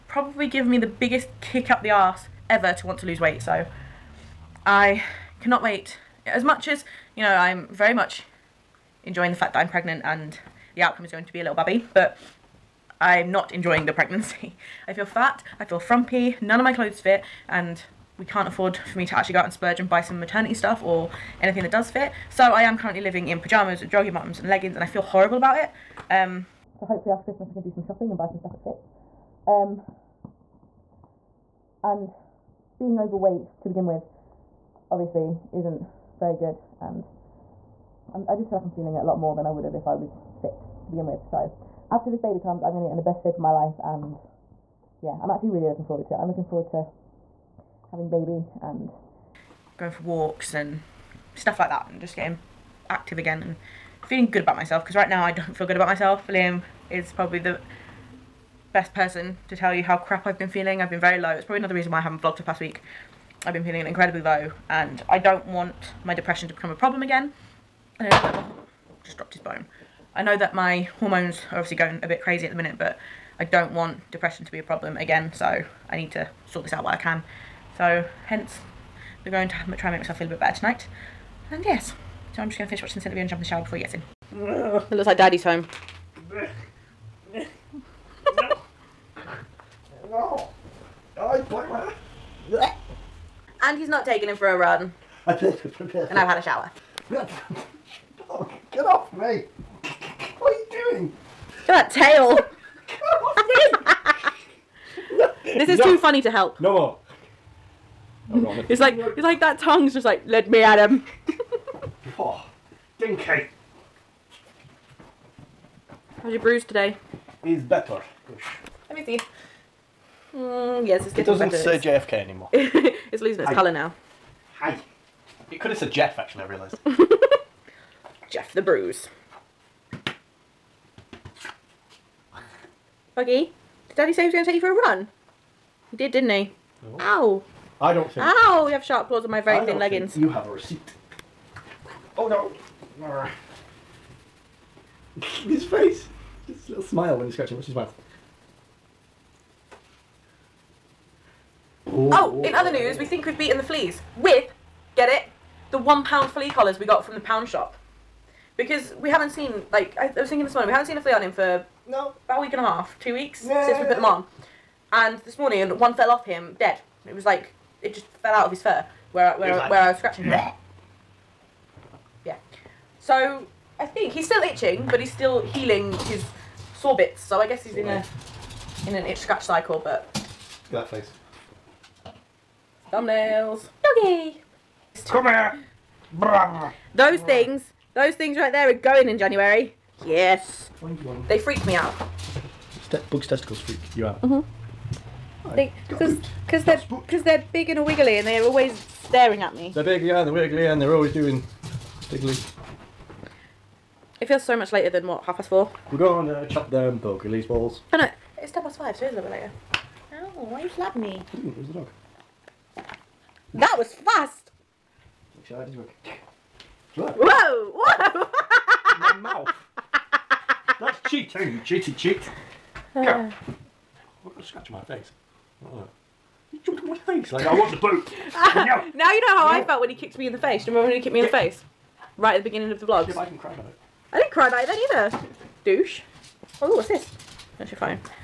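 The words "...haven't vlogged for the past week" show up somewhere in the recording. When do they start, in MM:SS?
01:02.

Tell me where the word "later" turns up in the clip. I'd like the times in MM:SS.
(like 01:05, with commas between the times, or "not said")
03:24, 03:29.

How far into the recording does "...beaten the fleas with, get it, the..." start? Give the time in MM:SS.
02:33.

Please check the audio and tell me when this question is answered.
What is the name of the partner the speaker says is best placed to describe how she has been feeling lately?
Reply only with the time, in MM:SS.
00:56.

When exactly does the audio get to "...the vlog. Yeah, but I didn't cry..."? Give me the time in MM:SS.
03:52.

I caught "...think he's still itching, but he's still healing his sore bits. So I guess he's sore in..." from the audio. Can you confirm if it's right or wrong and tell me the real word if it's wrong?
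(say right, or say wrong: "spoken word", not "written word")
right.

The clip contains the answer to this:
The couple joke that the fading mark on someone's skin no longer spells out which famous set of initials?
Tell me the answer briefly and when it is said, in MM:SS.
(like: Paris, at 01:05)
JFK, at 02:01.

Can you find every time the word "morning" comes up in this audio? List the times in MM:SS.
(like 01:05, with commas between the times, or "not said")
02:40, 02:45.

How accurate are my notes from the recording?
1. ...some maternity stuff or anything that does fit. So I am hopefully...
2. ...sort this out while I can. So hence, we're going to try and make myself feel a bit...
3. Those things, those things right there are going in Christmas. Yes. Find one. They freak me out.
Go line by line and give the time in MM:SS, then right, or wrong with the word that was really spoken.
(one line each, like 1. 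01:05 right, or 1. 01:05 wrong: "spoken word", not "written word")
1. 00:20 wrong: "currently", not "hopefully"
2. 01:16 right
3. 03:06 wrong: "January", not "Christmas".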